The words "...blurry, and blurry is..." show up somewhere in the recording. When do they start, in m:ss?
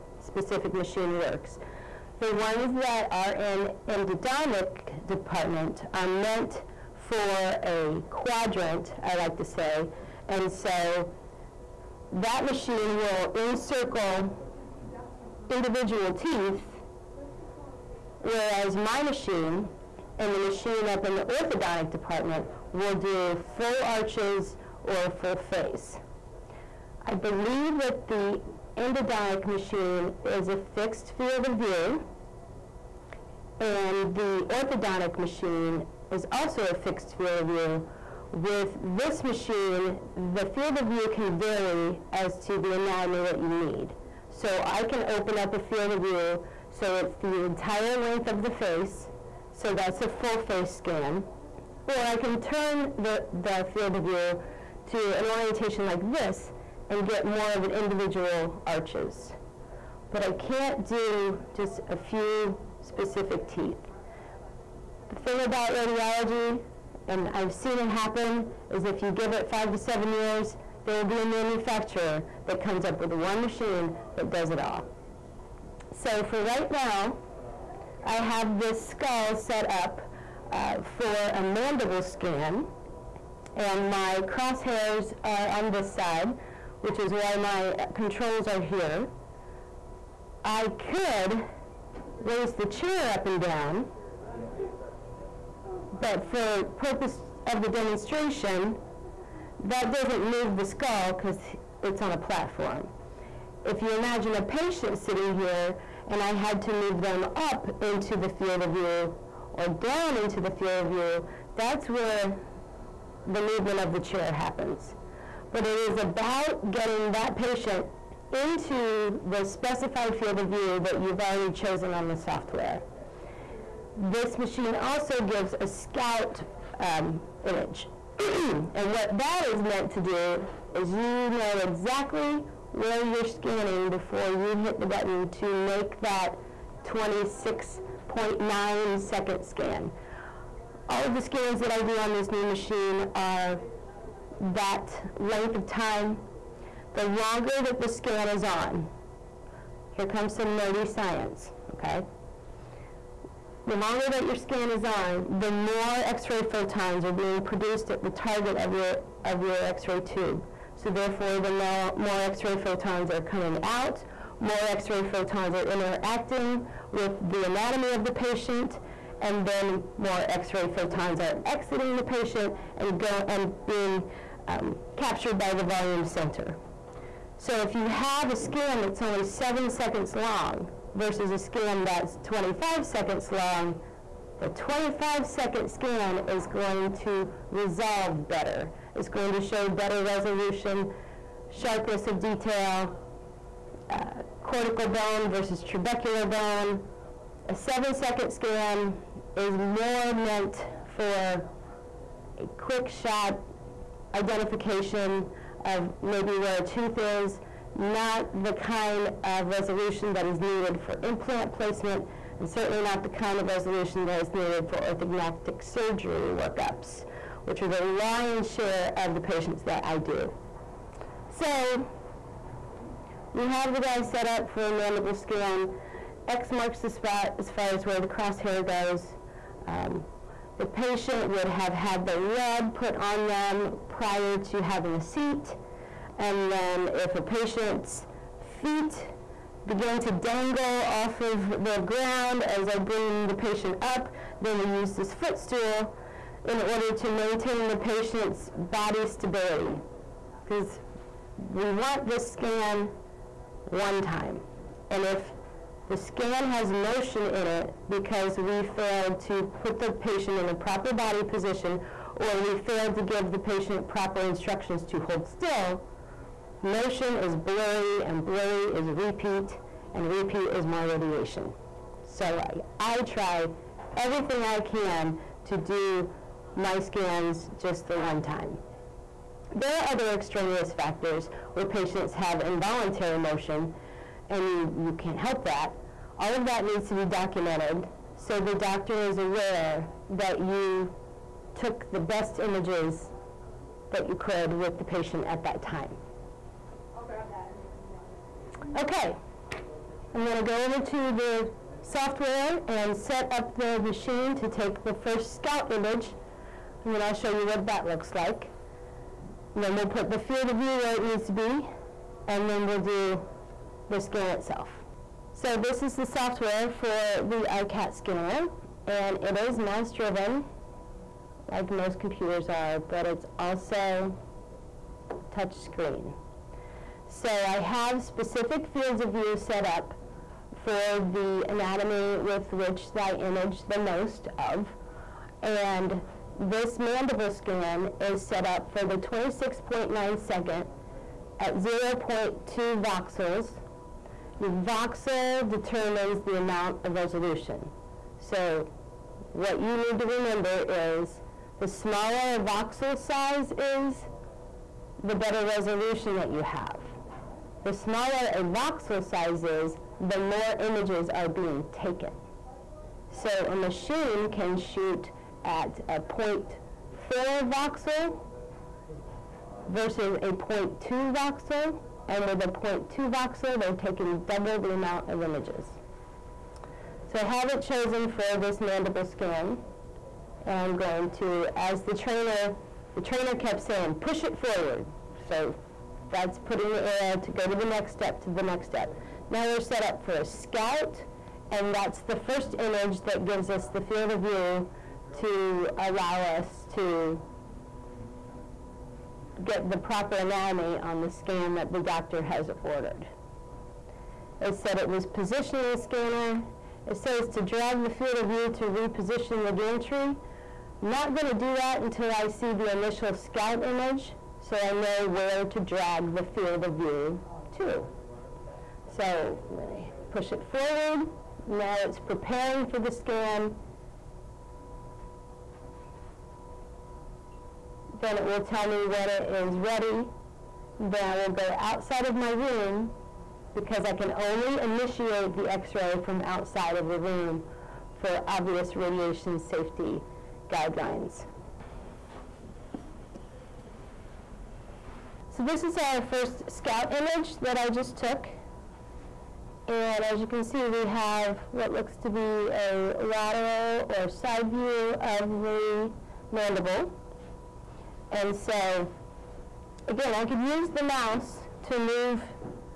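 4:27.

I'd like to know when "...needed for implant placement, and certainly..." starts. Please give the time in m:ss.
3:30.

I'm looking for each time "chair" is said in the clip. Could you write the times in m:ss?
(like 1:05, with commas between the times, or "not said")
1:32, 1:53.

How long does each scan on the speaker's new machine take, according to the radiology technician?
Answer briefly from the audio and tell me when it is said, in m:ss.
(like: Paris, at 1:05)
26.9 seconds, at 2:16.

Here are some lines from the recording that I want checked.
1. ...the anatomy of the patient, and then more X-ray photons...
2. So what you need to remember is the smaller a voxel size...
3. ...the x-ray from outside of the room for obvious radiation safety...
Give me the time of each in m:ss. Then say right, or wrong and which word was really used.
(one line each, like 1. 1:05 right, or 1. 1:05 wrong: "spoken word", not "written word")
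1. 2:47 right
2. 5:48 right
3. 7:15 right.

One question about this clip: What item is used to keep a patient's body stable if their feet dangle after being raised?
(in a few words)
Footstool.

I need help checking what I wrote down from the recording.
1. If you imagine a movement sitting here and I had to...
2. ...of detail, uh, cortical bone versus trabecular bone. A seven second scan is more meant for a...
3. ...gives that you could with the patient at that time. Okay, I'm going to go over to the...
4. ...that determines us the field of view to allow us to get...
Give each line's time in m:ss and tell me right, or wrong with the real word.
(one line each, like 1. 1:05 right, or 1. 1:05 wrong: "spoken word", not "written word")
1. 1:43 wrong: "patient", not "movement"
2. 3:12 right
3. 4:52 wrong: "images", not "gives"
4. 6:33 wrong: "gives", not "determines".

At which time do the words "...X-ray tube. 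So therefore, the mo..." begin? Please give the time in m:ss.
2:39.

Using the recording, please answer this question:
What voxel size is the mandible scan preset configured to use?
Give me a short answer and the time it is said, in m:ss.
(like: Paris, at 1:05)
0.2 voxels, at 5:41.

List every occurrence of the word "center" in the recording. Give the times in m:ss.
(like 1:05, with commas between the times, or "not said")
2:56.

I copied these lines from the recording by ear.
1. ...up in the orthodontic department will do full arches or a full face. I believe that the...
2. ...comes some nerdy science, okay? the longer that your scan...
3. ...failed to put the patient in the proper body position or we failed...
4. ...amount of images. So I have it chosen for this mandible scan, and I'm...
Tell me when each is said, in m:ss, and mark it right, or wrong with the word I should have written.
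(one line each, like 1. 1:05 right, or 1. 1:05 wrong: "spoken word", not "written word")
1. 0:20 right
2. 2:30 right
3. 4:18 right
4. 6:14 right.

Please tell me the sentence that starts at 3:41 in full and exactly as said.
So we have the guy set up for a mandible scan.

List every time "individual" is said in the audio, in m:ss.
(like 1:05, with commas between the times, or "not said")
0:15, 0:57.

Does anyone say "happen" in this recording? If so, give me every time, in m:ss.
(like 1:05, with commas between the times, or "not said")
1:07, 1:54.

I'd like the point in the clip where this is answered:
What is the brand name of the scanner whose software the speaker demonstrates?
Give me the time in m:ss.
5:17.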